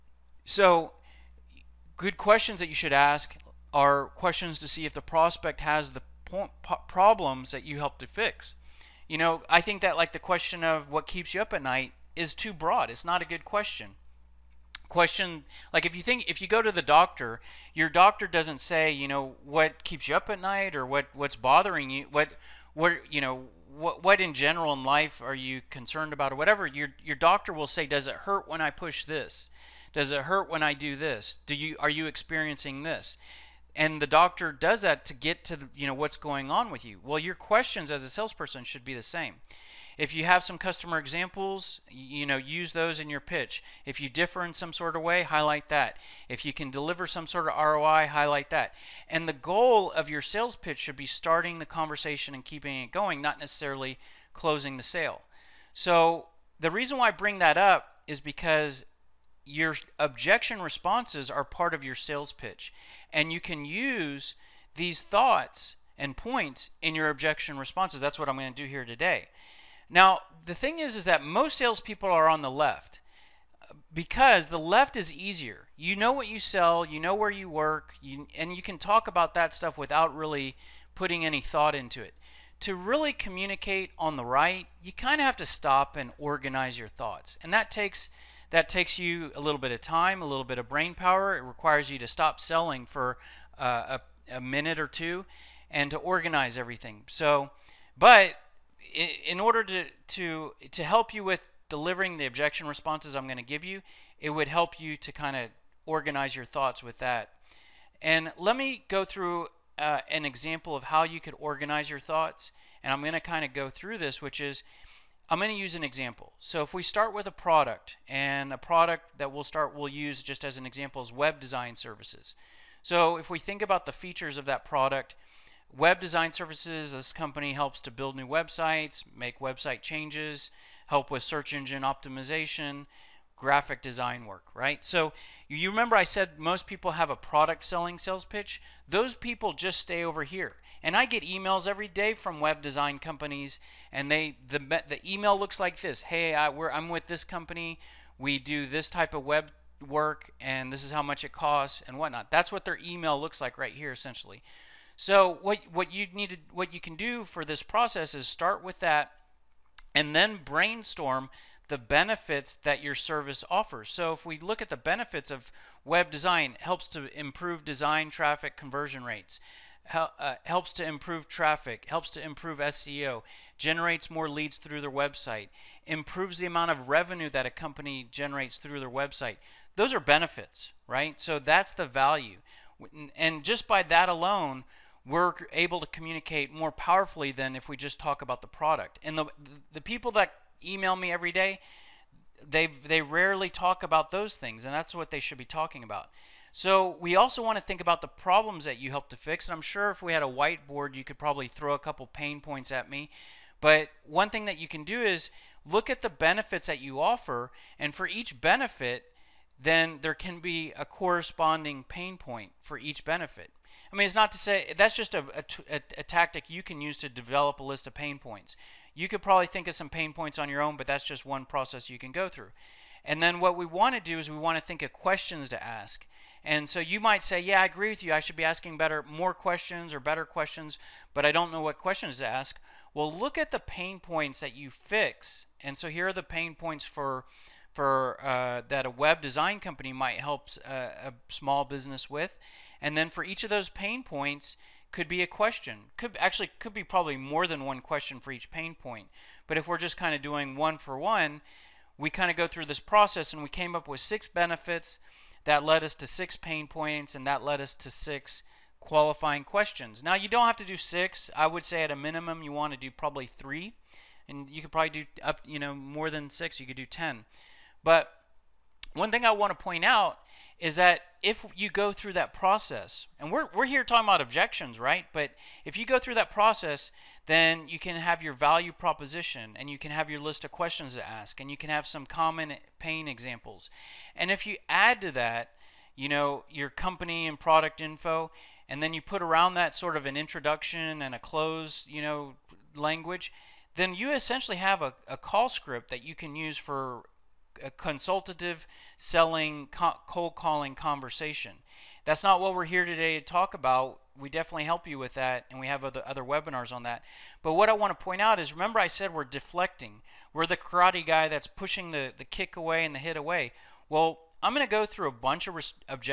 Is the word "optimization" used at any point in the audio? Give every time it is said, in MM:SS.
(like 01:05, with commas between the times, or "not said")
02:11.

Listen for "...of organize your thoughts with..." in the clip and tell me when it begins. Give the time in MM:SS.
01:45.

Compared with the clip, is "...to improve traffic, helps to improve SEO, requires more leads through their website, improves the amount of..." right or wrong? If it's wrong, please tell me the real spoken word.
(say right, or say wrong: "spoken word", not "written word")
wrong: "generates", not "requires".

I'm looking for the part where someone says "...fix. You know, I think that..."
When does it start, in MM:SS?
00:08.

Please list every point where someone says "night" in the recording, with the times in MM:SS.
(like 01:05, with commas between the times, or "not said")
00:11, 00:20.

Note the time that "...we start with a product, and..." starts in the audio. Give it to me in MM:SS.
01:56.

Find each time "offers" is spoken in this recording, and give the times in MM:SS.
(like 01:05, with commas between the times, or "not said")
02:43, 03:27.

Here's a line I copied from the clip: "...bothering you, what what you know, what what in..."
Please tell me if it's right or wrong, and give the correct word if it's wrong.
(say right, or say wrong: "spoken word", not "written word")
right.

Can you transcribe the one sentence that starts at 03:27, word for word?
And for each benefit, then there can be a corresponding pain point for each benefit.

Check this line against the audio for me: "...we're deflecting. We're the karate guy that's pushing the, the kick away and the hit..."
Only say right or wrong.
right.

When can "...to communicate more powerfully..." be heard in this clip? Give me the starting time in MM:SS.
03:05.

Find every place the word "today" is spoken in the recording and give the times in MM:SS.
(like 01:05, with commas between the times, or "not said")
01:08, 05:02.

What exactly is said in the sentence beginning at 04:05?
Could actually could be probably more than one question for each pain point.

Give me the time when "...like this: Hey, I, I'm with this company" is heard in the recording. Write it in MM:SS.
02:25.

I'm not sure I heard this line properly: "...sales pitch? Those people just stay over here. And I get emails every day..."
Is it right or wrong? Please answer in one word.
right.